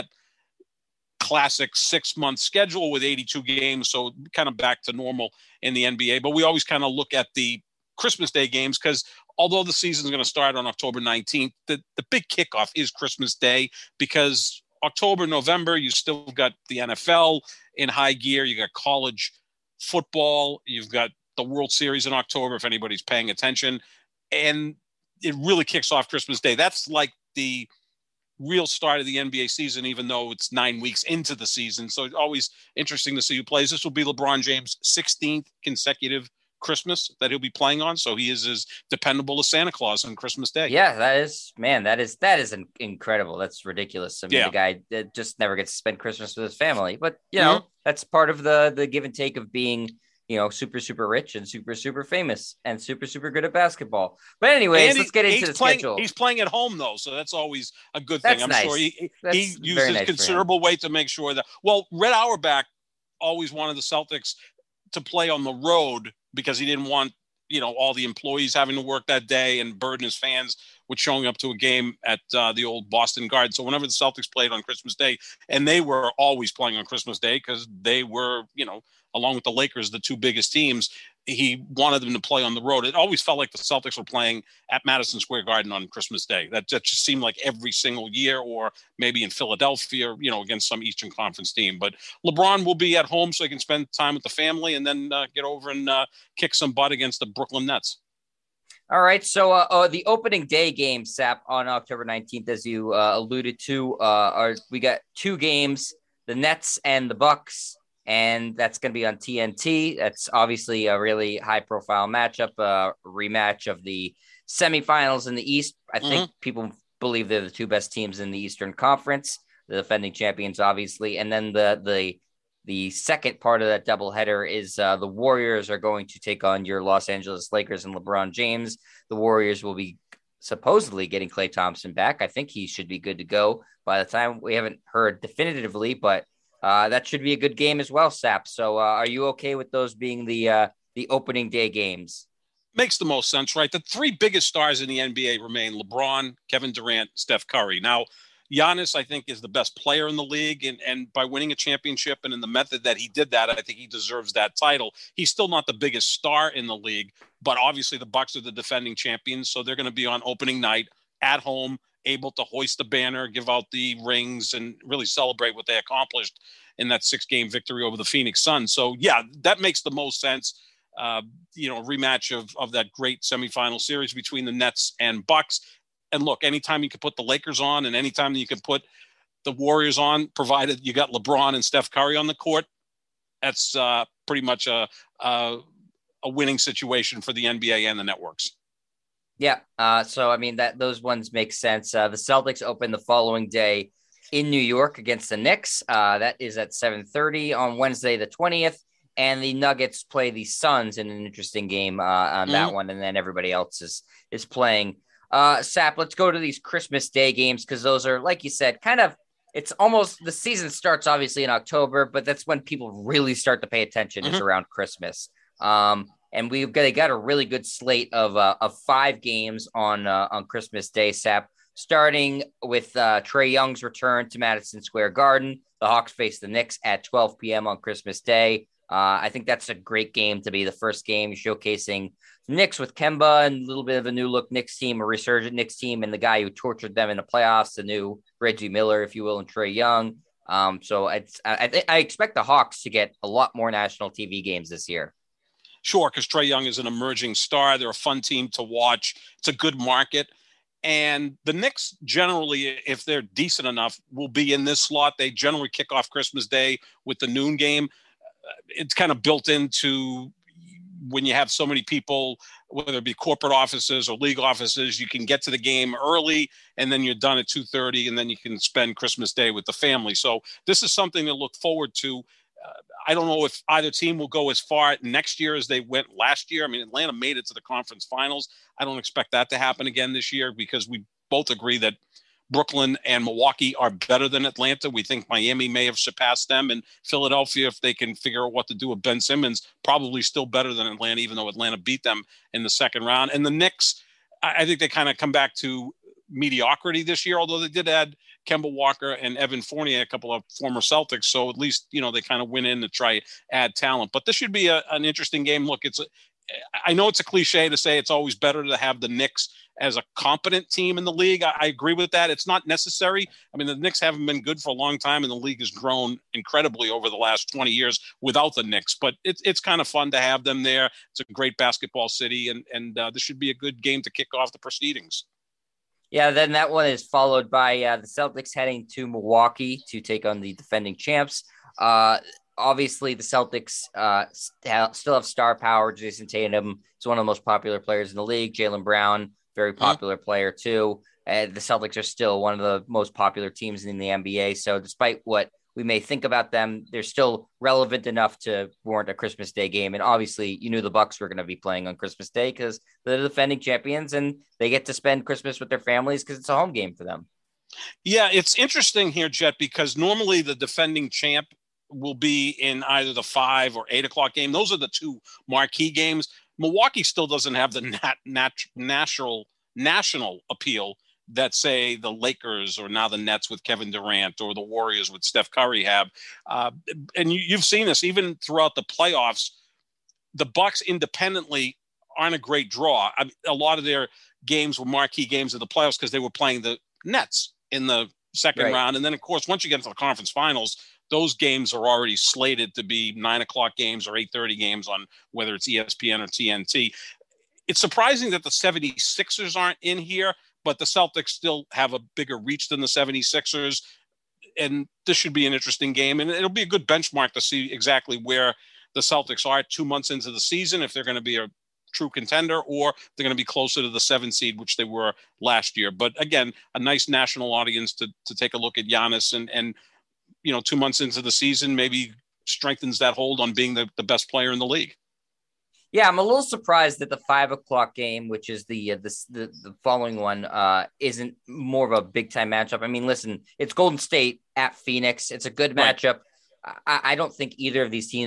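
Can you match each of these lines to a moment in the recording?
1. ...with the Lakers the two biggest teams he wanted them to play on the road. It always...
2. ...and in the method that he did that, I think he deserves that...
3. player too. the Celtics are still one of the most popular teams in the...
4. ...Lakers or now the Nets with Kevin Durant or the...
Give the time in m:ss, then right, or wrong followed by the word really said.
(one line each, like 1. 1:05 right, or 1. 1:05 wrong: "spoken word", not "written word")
1. 1:19 right
2. 2:32 right
3. 5:40 right
4. 6:12 right.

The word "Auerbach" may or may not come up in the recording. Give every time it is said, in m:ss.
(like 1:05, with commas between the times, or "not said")
1:02.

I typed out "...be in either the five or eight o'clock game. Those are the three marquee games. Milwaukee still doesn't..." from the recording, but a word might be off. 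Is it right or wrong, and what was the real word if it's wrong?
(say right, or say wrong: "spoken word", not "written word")
wrong: "two", not "three".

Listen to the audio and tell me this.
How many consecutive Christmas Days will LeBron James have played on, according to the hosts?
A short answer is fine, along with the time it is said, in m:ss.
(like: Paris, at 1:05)
16th, at 0:34.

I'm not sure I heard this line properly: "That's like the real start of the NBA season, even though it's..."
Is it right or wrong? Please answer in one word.
right.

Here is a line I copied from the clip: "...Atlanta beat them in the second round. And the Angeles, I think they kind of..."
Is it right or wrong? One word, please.
wrong.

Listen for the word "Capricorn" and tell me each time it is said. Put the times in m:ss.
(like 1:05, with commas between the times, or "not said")
not said.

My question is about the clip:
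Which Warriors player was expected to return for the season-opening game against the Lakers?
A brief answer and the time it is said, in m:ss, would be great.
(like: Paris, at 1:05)
Klay Thompson, at 2:11.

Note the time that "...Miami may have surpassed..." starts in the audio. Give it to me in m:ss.
4:45.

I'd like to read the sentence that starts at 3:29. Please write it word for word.
It's almost the season starts obviously in October, but that's when people really start to pay attention mm-hmm.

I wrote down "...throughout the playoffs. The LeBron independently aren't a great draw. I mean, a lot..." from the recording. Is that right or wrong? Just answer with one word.
wrong.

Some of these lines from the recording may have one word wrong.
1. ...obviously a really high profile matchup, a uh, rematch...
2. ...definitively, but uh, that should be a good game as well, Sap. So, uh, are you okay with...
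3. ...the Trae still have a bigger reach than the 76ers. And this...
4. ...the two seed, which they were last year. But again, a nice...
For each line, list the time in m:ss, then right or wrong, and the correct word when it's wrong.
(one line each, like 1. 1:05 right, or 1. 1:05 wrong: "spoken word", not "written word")
1. 1:50 right
2. 2:15 right
3. 6:40 wrong: "Celtics", not "Trae"
4. 6:53 wrong: "seven", not "two".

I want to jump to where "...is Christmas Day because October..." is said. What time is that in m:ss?
0:12.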